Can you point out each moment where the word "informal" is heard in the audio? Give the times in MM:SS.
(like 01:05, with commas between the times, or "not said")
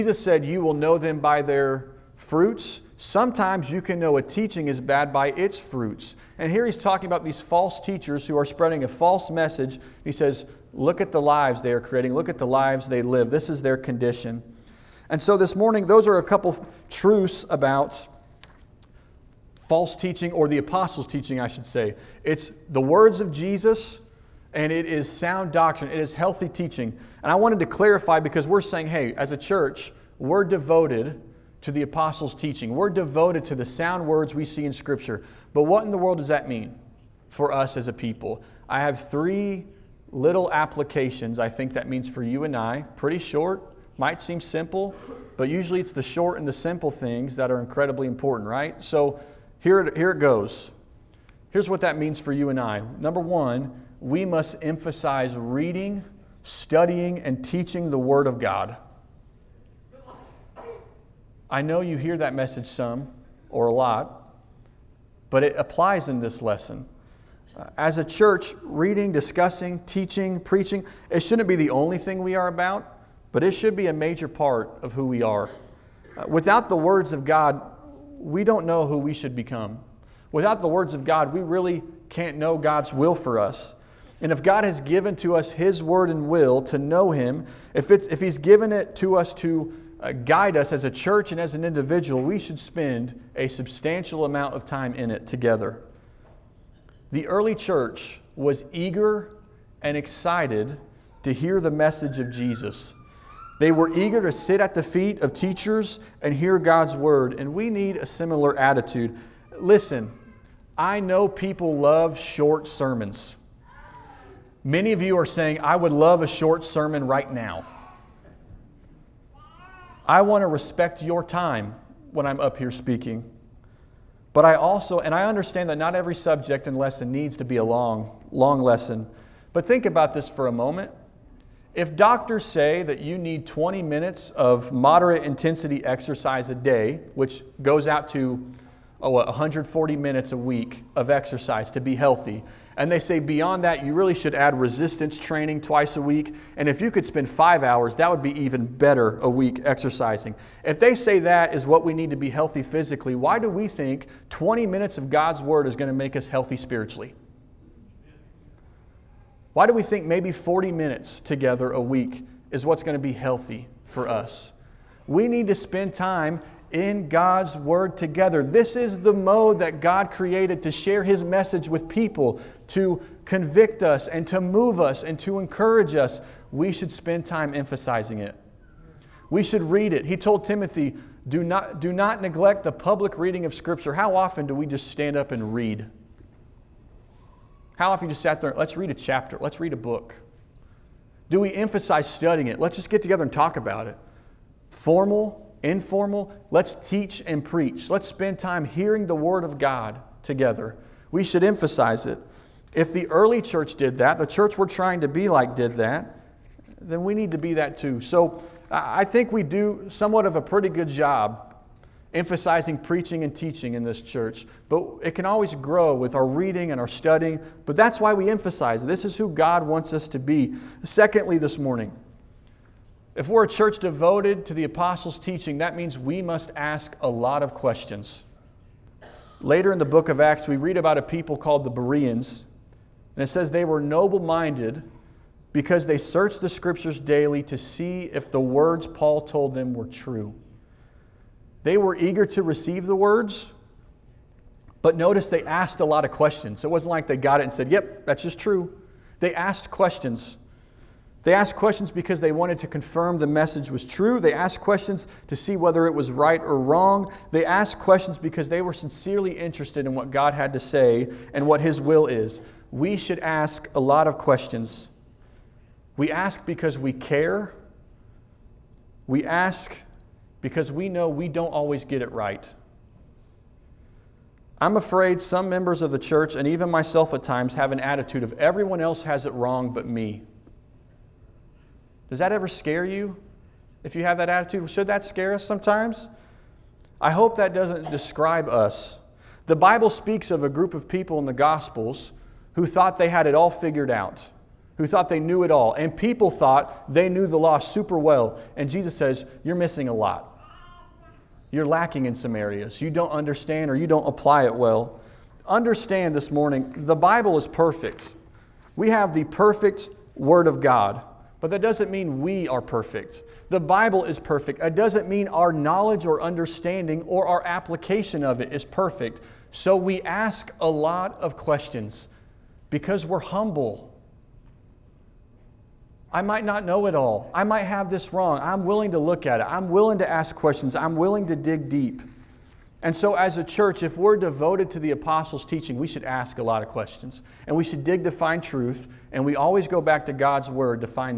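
03:15.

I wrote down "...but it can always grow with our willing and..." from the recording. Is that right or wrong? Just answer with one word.
wrong.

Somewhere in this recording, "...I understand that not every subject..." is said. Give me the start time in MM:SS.
02:05.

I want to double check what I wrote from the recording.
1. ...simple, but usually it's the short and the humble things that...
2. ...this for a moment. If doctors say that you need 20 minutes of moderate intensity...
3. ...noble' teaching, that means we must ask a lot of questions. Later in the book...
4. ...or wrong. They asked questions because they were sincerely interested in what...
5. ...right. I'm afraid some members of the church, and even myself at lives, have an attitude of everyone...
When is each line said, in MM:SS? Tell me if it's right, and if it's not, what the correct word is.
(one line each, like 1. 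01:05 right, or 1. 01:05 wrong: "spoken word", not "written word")
1. 00:44 wrong: "simple", not "humble"
2. 02:10 right
3. 03:44 wrong: "apostles", not "noble"
4. 04:16 right
5. 04:32 wrong: "times", not "lives".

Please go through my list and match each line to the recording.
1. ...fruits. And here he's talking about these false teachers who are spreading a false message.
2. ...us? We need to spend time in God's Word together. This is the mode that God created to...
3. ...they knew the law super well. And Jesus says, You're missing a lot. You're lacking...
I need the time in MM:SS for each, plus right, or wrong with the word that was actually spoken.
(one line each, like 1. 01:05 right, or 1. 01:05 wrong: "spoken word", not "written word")
1. 00:05 right
2. 02:44 right
3. 04:56 right.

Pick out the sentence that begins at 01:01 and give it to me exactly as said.
I know you hear that message some or a lot, but it applies in this lesson.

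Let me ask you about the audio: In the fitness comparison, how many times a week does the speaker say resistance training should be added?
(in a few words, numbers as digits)
twice.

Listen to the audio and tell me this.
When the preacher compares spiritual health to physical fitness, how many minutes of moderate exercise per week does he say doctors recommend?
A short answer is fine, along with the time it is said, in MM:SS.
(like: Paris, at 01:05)
140, at 02:19.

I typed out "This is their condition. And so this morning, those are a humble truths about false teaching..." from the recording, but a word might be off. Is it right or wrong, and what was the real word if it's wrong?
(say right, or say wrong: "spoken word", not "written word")
wrong: "couple", not "humble".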